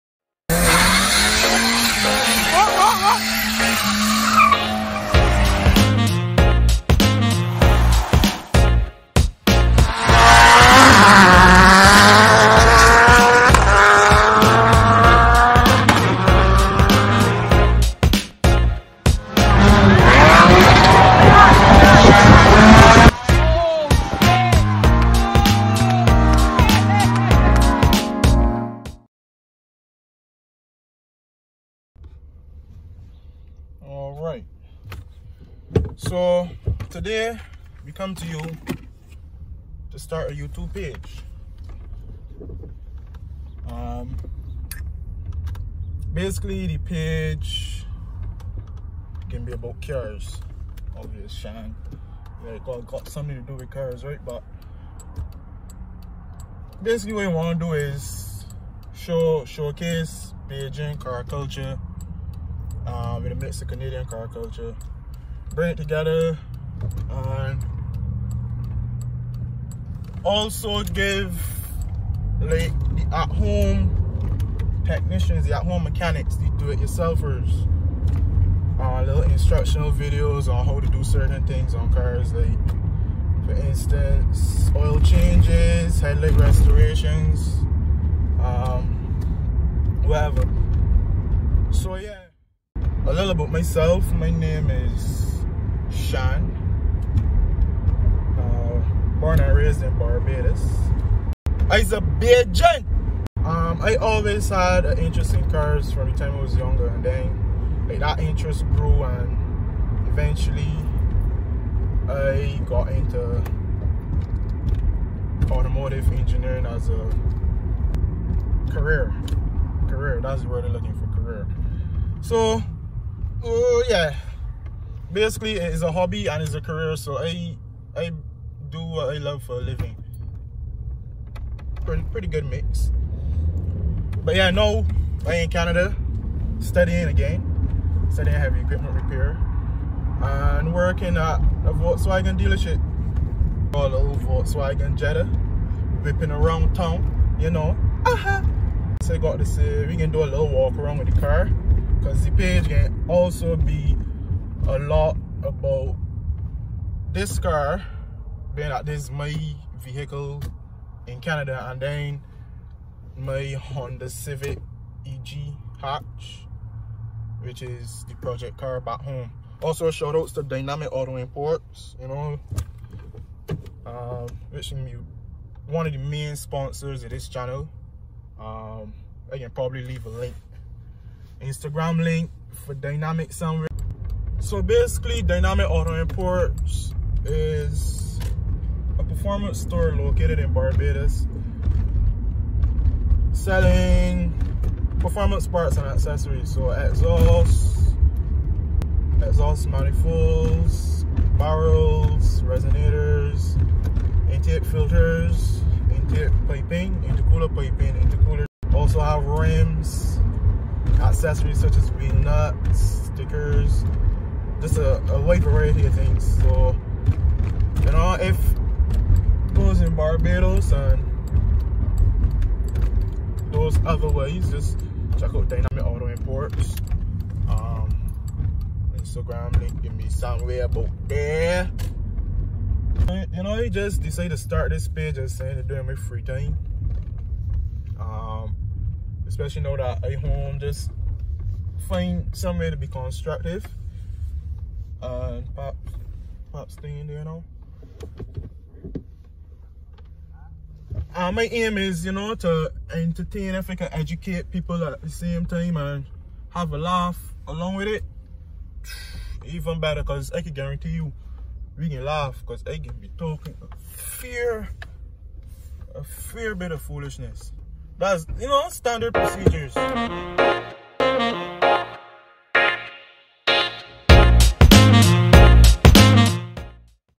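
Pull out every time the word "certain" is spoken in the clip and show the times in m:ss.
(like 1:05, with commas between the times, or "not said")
1:21.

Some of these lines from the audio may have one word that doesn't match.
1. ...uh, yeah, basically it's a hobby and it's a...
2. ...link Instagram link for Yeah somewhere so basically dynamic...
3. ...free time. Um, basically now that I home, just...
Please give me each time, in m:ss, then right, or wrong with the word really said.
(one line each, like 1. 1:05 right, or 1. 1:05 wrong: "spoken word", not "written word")
1. 2:03 right
2. 3:00 wrong: "Dynamic", not "Yeah"
3. 3:55 wrong: "especially", not "basically".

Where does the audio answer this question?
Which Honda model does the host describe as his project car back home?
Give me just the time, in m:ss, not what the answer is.
2:43.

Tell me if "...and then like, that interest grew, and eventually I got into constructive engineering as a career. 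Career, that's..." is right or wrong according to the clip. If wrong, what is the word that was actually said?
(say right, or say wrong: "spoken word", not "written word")
wrong: "automotive", not "constructive".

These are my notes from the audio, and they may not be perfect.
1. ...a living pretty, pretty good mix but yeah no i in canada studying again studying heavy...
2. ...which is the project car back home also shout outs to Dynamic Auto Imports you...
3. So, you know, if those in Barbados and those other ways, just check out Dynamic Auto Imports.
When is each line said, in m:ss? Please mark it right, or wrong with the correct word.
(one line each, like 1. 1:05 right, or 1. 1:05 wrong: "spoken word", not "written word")
1. 2:09 right
2. 2:47 right
3. 3:36 right.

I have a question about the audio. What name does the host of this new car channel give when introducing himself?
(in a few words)
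Sunshine.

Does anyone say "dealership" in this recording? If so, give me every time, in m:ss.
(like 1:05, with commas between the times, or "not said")
2:22.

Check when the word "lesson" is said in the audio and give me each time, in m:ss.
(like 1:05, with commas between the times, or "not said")
not said.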